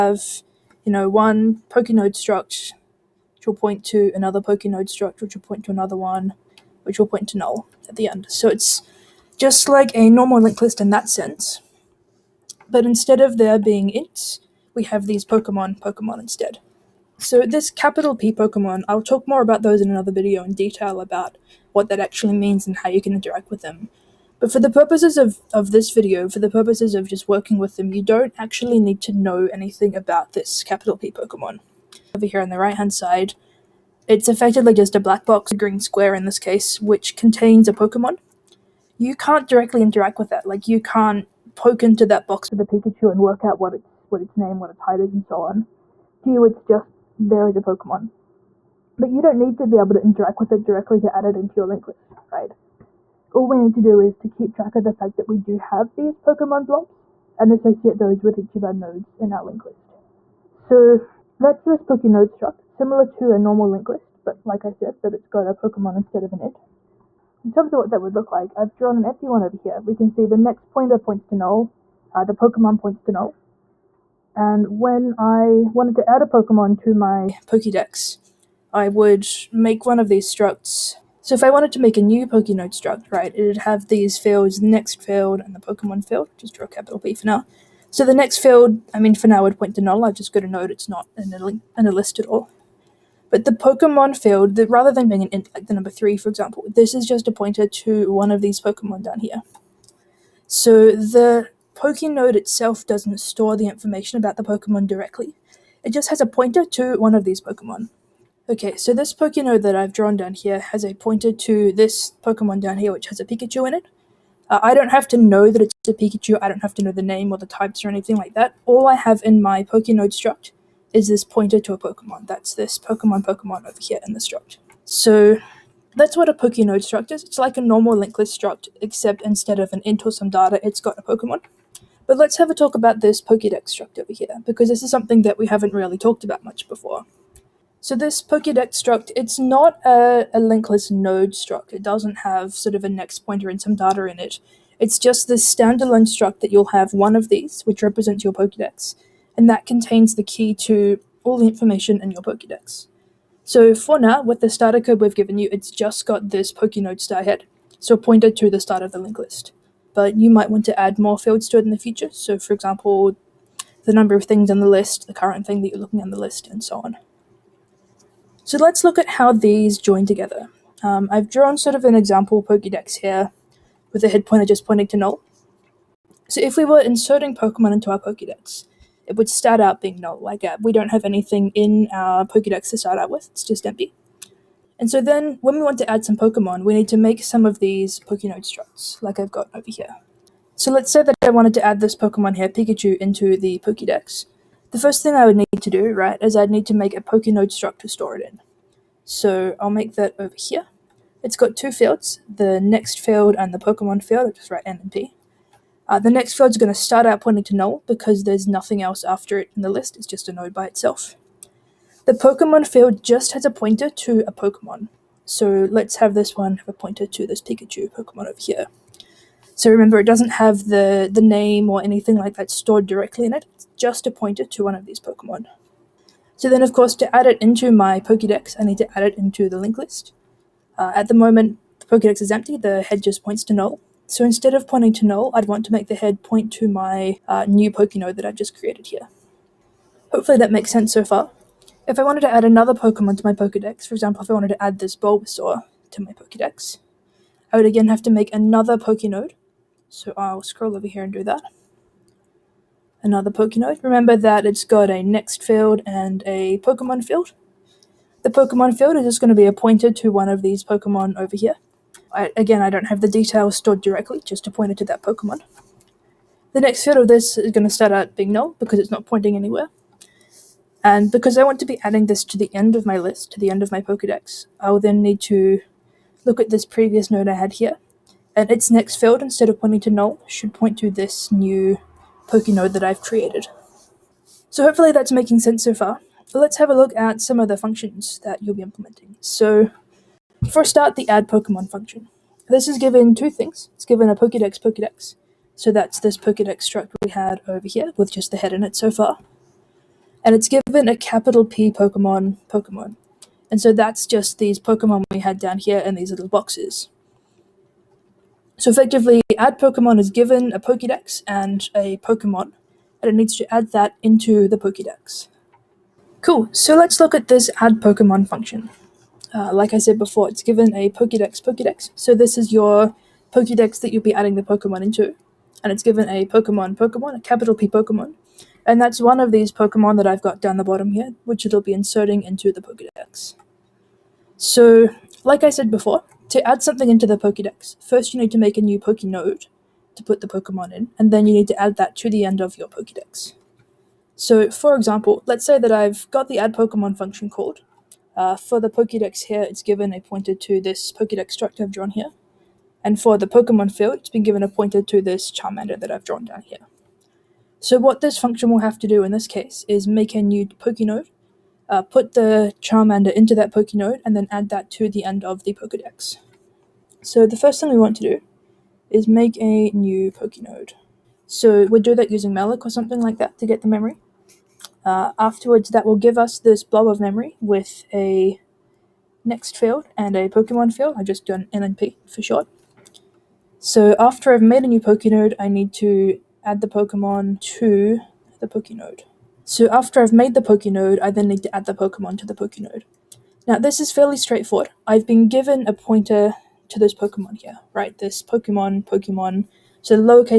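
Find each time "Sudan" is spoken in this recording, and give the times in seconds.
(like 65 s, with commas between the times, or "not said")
not said.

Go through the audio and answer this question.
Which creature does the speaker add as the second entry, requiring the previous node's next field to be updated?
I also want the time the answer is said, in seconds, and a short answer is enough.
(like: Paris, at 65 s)
Bulbasaur, at 244 s.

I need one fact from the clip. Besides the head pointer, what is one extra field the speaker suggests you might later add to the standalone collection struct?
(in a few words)
the number of things on the list.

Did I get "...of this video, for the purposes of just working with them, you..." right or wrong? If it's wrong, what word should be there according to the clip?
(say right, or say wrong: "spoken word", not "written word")
right.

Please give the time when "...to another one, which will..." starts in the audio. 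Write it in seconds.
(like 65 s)
5 s.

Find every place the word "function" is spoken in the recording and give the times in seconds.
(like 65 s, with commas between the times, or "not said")
287 s, 291 s, 318 s, 346 s, 358 s.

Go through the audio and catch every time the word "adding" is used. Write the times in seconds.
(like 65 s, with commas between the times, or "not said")
271 s, 324 s.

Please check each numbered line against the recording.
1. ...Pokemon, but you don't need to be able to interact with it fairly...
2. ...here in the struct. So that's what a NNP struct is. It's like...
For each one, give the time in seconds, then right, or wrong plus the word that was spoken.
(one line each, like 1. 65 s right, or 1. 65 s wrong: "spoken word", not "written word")
1. 47 s wrong: "directly", not "fairly"
2. 123 s wrong: "Pokenode", not "NNP".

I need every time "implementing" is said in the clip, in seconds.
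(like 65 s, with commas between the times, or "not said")
288 s.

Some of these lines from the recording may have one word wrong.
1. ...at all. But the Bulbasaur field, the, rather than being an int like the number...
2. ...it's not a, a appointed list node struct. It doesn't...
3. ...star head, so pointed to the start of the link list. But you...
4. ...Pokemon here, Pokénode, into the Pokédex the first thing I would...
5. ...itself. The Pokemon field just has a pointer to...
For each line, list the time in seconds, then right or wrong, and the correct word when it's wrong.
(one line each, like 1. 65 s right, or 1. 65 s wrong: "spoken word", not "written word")
1. 92 s wrong: "Pokemon", not "Bulbasaur"
2. 139 s wrong: "linked", not "appointed"
3. 156 s right
4. 191 s wrong: "Pikachu", not "Pokénode"
5. 210 s right.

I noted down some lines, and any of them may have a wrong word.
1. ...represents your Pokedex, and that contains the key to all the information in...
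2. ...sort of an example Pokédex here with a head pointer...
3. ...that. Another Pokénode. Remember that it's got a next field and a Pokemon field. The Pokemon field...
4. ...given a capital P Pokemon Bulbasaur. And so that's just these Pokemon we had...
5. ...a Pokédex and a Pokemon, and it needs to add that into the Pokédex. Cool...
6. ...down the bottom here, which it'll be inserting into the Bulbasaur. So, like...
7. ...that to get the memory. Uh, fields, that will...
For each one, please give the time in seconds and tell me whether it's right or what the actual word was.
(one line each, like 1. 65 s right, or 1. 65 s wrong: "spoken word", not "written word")
1. 147 s right
2. 171 s right
3. 251 s right
4. 300 s wrong: "Pokemon", not "Bulbasaur"
5. 310 s right
6. 330 s wrong: "Pokédex", not "Bulbasaur"
7. 373 s wrong: "afterwards", not "fields".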